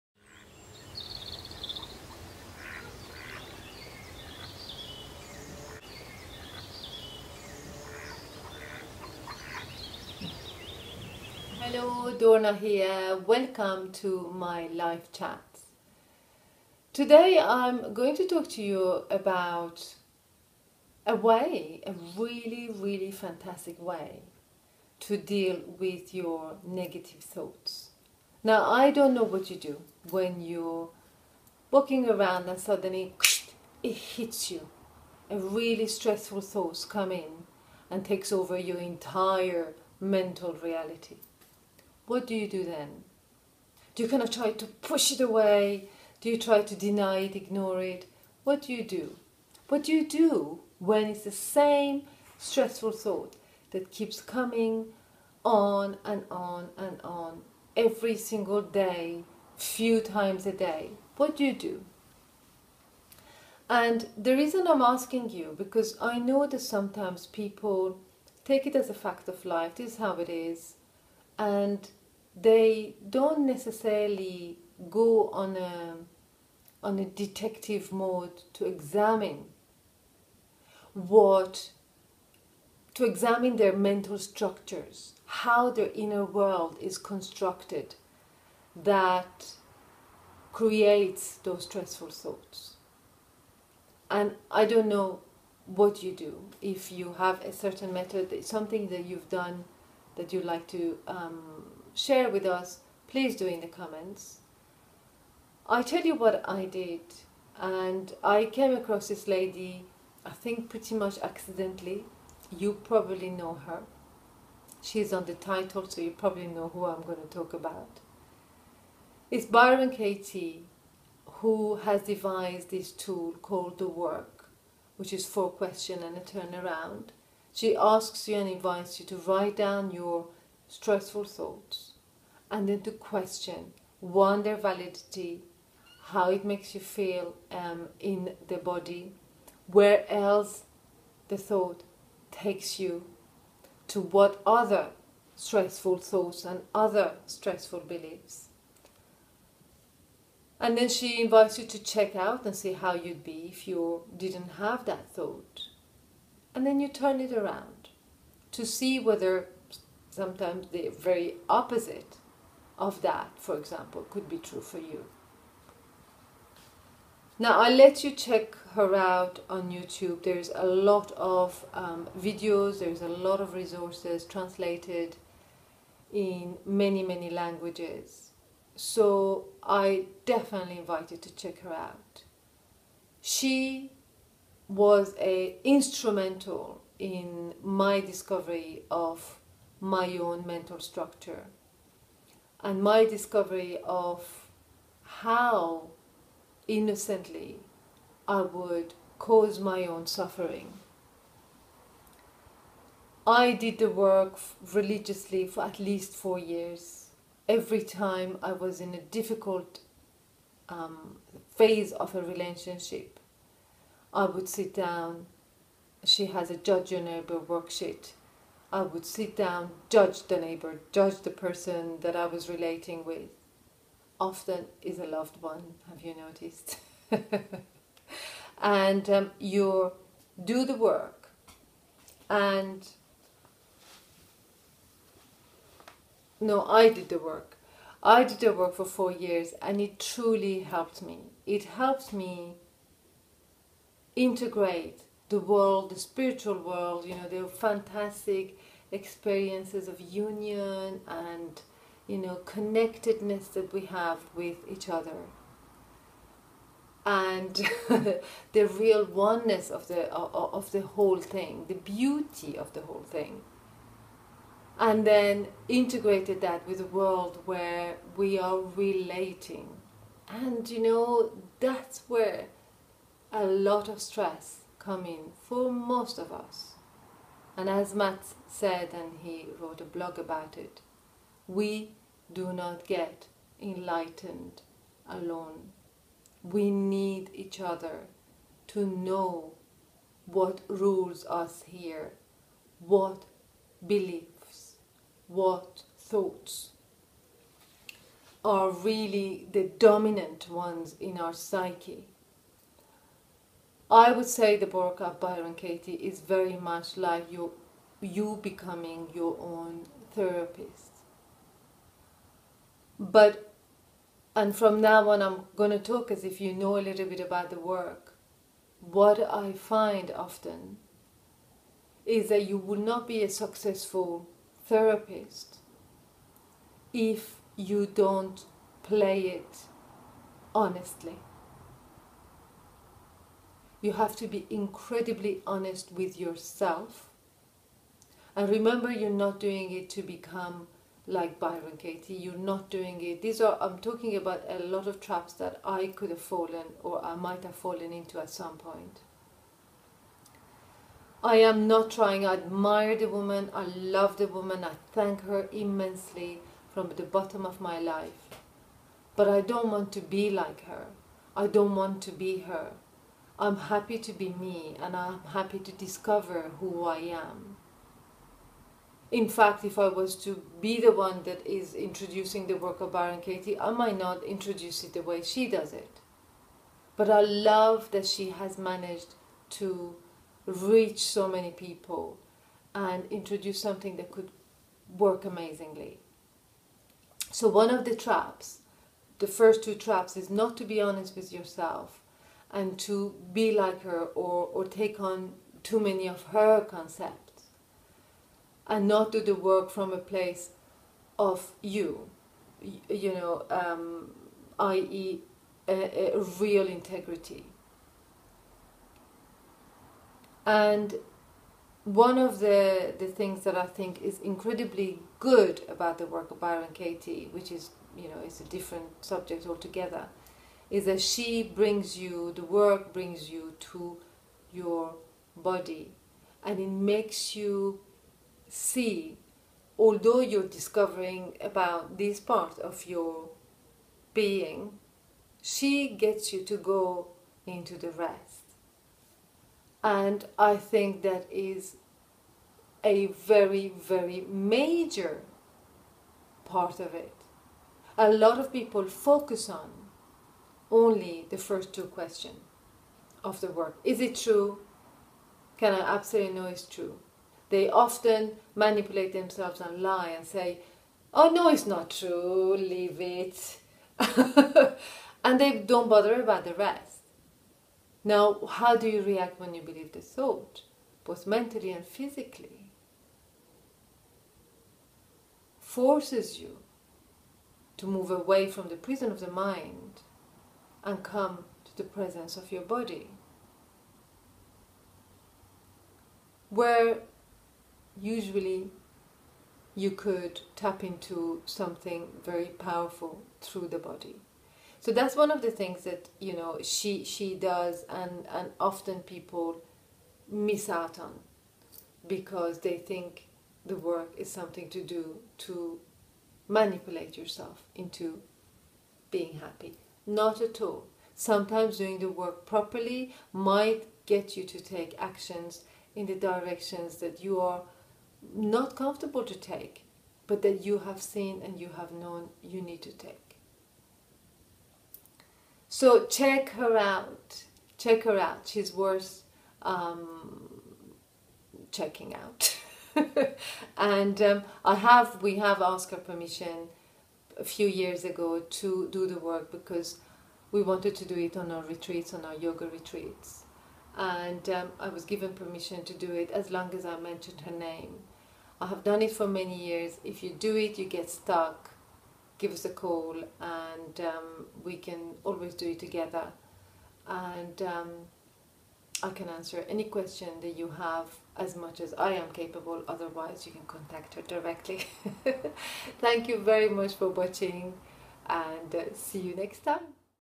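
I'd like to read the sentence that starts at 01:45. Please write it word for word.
I tell you what I did, and I came across this lady, I think pretty much accidentally.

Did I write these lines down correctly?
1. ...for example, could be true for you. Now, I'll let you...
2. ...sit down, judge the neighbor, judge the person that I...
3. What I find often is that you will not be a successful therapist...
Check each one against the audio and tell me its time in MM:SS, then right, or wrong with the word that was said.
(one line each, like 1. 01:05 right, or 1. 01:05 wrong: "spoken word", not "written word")
1. 02:43 right
2. 03:39 right
3. 05:18 right.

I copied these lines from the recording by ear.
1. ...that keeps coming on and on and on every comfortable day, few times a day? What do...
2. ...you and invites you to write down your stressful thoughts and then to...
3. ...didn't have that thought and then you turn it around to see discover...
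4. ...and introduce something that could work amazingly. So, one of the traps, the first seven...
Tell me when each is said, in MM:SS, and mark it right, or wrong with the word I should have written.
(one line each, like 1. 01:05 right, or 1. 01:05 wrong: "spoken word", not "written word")
1. 00:53 wrong: "single", not "comfortable"
2. 02:08 right
3. 02:34 wrong: "whether", not "discover"
4. 06:22 wrong: "two", not "seven".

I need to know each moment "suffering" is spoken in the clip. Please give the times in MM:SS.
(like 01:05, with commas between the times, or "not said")
03:20.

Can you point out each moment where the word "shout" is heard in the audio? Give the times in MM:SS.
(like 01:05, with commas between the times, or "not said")
not said.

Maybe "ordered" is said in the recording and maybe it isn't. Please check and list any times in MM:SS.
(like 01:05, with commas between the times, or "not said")
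not said.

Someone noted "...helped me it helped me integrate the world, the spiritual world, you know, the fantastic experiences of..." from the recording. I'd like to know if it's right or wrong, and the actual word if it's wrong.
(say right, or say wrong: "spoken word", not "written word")
right.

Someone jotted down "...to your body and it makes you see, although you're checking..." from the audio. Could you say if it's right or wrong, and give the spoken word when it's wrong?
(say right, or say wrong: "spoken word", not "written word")
wrong: "discovering", not "checking".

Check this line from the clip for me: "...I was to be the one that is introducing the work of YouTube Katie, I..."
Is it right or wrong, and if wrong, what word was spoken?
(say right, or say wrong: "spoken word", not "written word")
wrong: "Byron", not "YouTube".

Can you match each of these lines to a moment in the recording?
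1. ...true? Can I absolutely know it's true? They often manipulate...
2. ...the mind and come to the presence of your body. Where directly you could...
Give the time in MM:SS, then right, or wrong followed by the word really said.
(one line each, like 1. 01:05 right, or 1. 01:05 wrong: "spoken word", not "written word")
1. 07:34 right
2. 07:59 wrong: "usually", not "directly".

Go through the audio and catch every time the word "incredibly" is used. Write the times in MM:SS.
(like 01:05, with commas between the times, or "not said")
05:34, 06:54.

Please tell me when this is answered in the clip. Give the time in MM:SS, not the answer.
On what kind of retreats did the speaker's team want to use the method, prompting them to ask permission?
09:02.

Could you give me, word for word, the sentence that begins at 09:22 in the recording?
Otherwise, you can contact her directly.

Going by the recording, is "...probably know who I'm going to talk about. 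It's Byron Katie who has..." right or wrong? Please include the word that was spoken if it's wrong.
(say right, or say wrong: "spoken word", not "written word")
right.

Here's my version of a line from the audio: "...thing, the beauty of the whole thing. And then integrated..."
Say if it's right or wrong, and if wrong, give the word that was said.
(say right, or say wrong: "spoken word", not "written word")
right.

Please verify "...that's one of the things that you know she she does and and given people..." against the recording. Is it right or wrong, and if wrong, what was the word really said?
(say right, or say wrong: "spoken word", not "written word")
wrong: "often", not "given".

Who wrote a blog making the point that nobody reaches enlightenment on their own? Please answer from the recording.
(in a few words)
Matt.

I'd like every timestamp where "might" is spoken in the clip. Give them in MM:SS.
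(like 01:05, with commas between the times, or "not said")
05:47, 06:13, 08:33.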